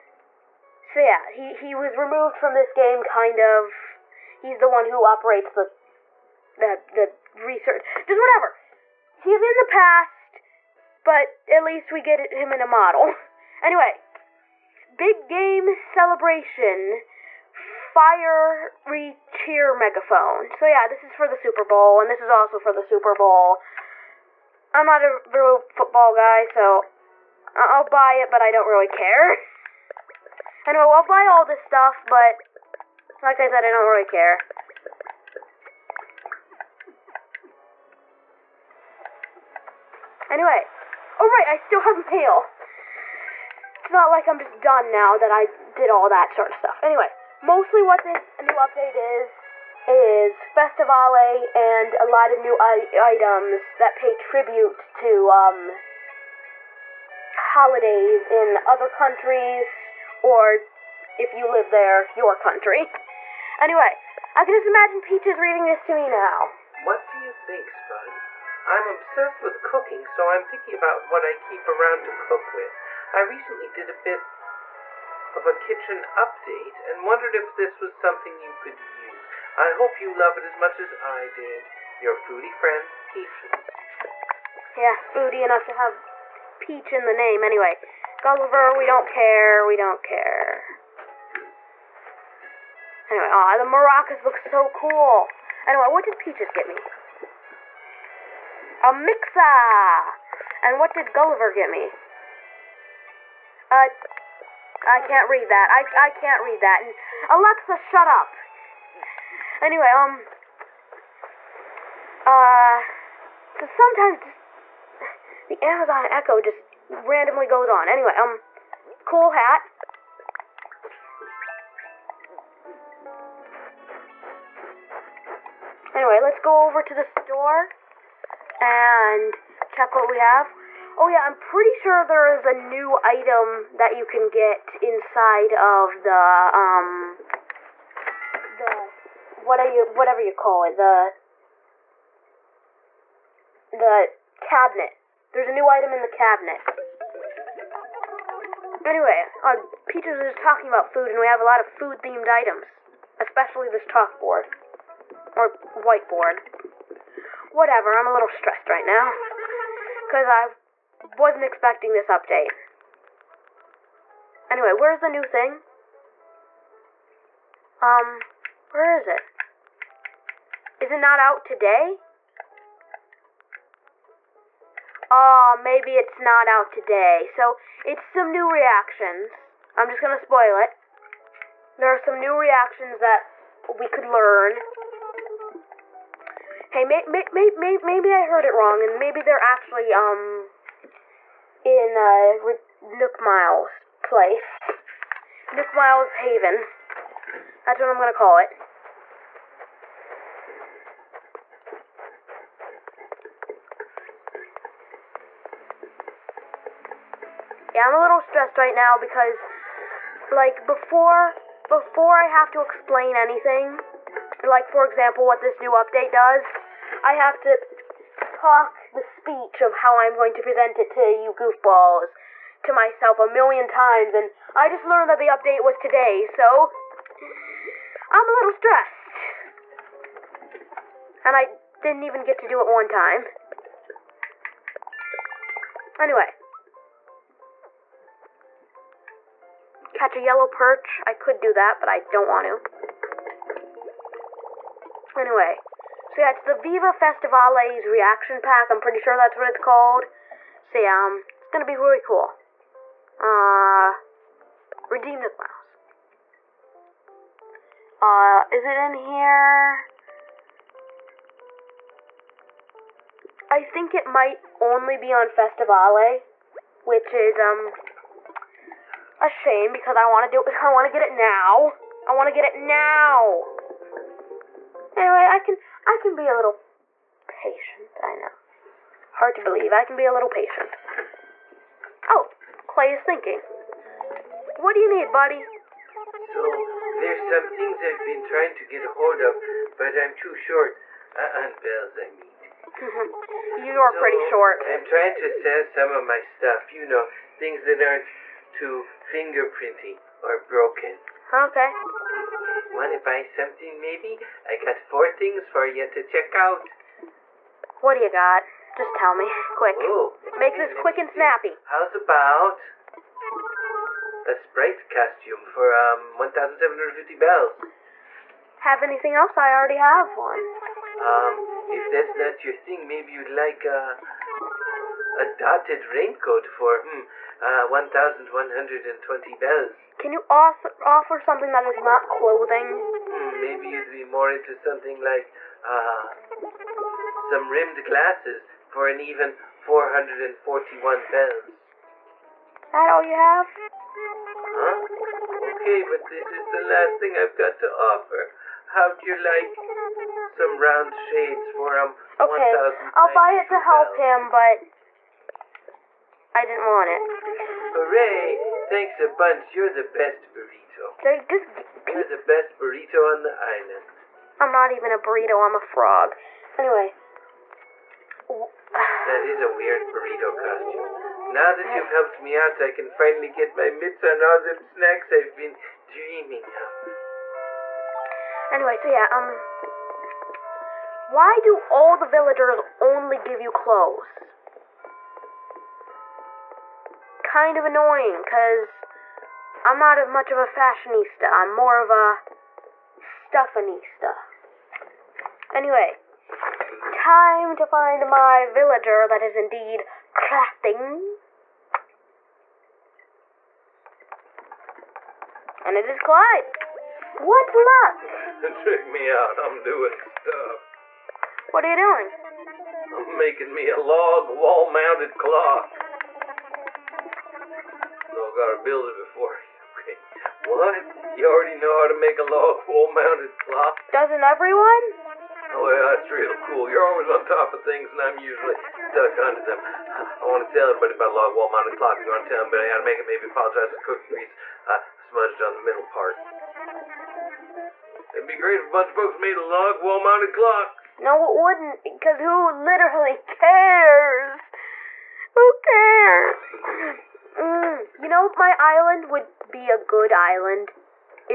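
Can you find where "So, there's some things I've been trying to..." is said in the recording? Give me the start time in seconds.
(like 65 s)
286 s.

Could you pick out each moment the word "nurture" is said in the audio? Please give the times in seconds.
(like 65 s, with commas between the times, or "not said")
not said.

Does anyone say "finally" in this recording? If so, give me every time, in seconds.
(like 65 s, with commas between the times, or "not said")
372 s.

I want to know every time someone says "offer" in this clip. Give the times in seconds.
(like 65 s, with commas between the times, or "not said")
330 s, 347 s.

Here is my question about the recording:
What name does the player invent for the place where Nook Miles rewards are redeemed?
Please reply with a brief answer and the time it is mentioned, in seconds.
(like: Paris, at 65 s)
Nook Miles' haven, at 195 s.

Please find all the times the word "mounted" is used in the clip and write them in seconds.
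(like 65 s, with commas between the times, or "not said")
414 s, 422 s, 431 s, 439 s.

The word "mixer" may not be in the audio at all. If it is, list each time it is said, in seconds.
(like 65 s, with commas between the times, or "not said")
98 s.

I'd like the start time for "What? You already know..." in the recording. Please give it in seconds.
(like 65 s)
420 s.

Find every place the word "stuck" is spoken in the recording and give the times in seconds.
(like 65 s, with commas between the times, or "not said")
428 s.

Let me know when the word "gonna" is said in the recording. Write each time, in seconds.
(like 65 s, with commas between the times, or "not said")
180 s, 197 s, 251 s.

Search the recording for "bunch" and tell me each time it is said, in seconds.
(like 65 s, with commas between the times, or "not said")
359 s, 438 s.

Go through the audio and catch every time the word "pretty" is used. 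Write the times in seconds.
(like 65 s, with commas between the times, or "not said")
131 s, 248 s, 294 s.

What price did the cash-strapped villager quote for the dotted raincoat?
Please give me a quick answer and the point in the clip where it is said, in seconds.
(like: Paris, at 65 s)
1,120 bells, at 327 s.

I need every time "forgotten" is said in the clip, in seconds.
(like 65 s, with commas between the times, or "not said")
not said.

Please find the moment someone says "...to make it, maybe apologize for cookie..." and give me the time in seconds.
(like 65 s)
432 s.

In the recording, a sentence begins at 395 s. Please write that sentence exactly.
Anyway, time to find my villager that is indeed crafting.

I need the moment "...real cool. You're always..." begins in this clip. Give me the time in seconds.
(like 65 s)
426 s.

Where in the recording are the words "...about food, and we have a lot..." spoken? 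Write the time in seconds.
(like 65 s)
150 s.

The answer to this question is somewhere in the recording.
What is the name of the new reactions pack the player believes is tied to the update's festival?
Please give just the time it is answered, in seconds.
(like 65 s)
246 s.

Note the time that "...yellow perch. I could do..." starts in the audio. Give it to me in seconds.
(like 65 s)
240 s.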